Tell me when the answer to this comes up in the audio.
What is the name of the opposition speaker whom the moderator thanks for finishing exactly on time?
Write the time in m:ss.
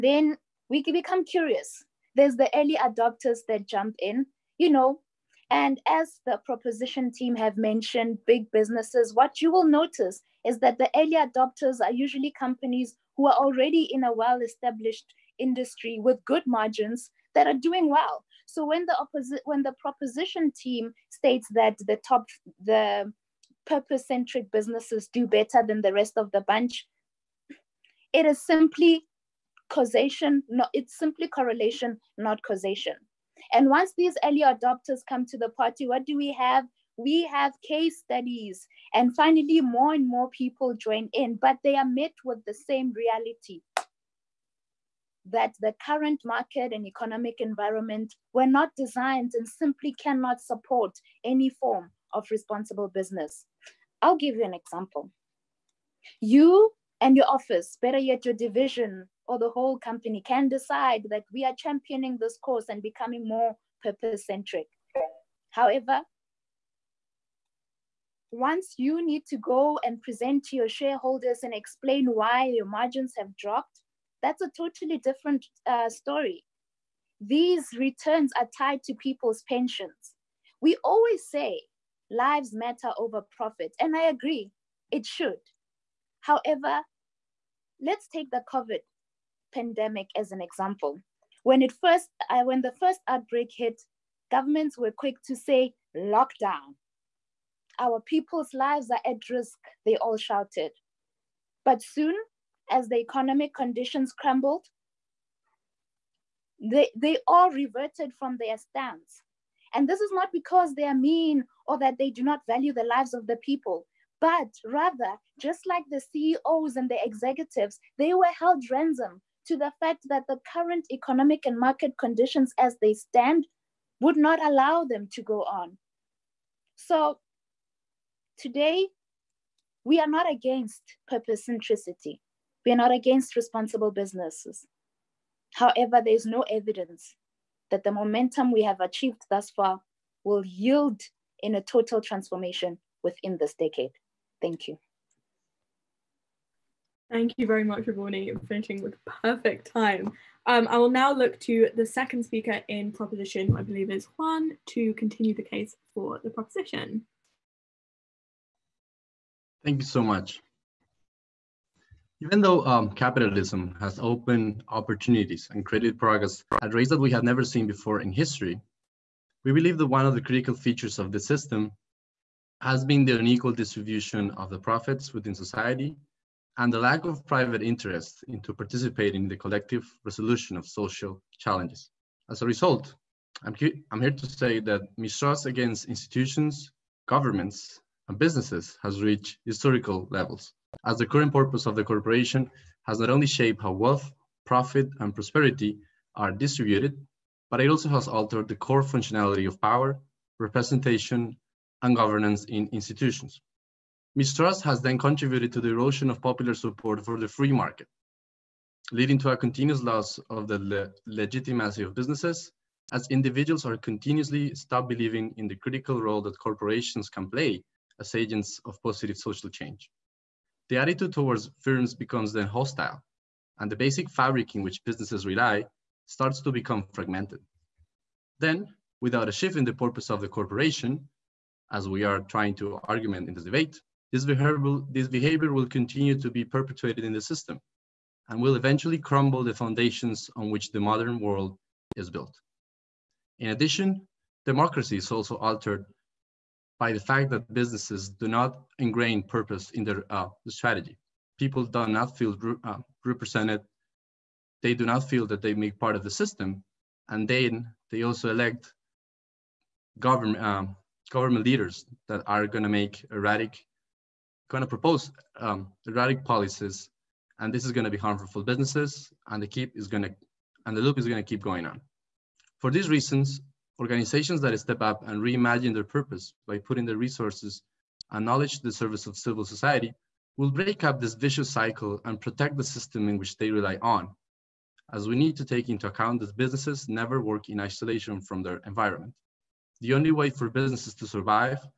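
2:27.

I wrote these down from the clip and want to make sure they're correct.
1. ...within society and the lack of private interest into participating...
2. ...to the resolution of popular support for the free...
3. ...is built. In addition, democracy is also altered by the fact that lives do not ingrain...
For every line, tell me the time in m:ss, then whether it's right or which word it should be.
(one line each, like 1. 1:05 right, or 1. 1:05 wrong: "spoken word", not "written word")
1. 2:55 right
2. 3:25 wrong: "erosion", not "resolution"
3. 4:01 wrong: "businesses", not "lives".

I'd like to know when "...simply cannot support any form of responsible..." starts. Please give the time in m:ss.
0:49.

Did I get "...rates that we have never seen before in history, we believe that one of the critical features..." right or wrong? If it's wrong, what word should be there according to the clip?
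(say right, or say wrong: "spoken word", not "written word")
right.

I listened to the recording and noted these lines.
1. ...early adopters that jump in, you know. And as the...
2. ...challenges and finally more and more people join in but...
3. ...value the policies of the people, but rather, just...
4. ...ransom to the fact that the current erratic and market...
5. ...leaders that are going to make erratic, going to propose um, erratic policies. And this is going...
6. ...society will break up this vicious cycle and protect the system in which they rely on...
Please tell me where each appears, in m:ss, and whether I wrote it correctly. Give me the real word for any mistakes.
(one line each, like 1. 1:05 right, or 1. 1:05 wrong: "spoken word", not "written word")
1. 0:02 right
2. 0:37 wrong: "studies", not "challenges"
3. 1:52 wrong: "lives", not "policies"
4. 1:58 wrong: "economic", not "erratic"
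5. 4:21 right
6. 4:39 right.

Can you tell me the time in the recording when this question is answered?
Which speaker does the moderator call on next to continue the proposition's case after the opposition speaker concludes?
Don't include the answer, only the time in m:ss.
2:34.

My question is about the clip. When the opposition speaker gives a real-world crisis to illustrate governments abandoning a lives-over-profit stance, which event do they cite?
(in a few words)
COVID pandemic.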